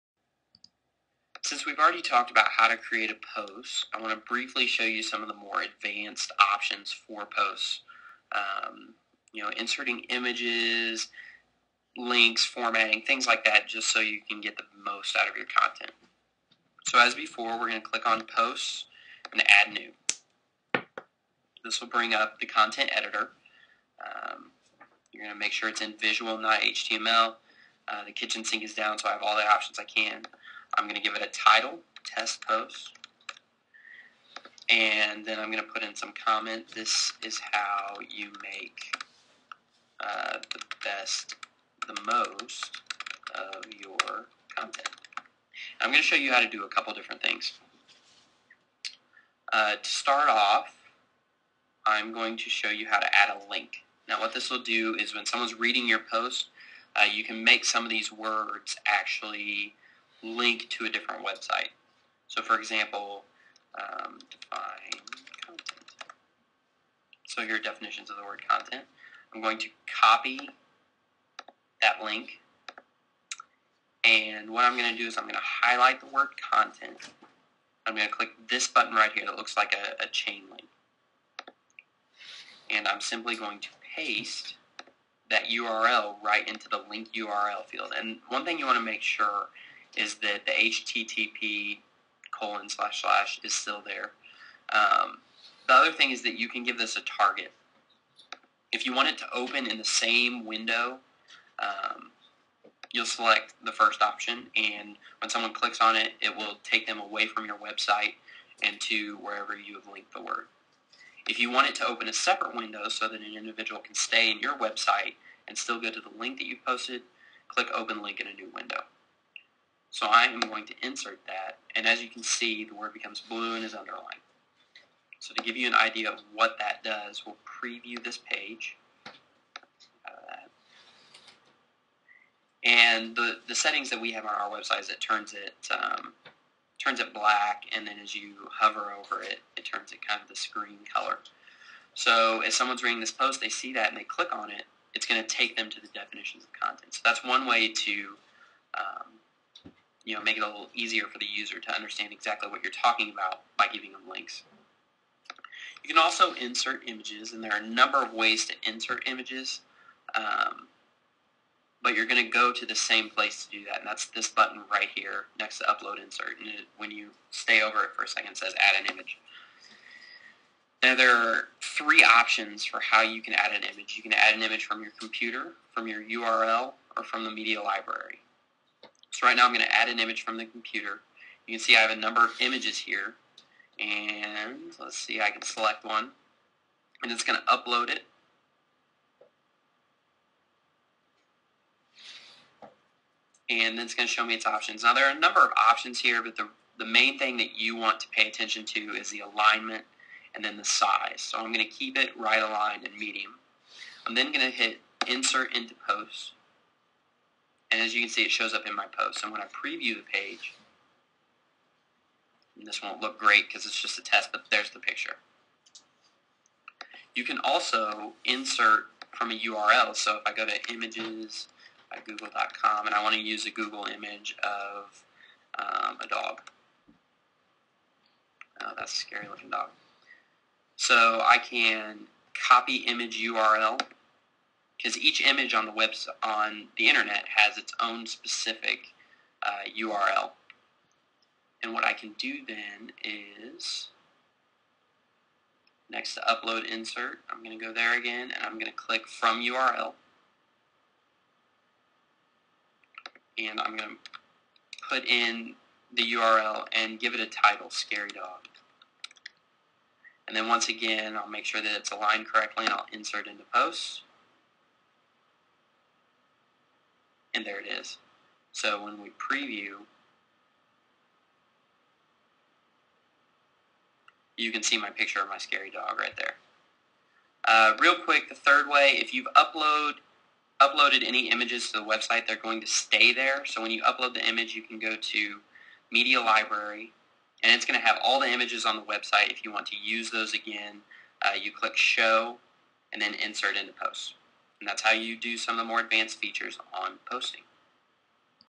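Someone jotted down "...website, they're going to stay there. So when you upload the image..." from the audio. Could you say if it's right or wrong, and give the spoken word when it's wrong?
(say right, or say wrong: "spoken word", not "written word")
right.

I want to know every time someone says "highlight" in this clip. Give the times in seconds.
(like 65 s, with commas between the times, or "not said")
75 s.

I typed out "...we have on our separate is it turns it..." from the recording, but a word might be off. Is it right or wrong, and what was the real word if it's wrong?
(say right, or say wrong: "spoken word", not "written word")
wrong: "website", not "separate".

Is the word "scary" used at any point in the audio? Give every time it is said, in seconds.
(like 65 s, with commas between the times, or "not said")
228 s, 257 s, 275 s.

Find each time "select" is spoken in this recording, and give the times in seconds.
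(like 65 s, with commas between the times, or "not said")
103 s, 185 s.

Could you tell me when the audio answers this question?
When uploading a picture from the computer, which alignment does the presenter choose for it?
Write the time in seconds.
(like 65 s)
202 s.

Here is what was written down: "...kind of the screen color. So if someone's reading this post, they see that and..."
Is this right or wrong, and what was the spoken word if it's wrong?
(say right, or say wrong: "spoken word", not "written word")
right.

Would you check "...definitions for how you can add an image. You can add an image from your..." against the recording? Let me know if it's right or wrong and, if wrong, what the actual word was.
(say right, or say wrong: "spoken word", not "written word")
wrong: "options", not "definitions".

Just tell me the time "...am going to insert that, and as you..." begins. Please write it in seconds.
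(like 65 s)
120 s.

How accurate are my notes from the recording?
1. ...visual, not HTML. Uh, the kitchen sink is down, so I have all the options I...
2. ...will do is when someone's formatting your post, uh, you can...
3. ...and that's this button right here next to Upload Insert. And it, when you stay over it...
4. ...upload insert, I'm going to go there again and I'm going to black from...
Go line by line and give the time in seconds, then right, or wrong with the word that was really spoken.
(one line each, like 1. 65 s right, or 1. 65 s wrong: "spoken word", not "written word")
1. 25 s right
2. 54 s wrong: "reading", not "formatting"
3. 163 s right
4. 246 s wrong: "click", not "black".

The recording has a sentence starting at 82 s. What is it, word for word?
And I'm simply going to paste that URL right into the link URL field.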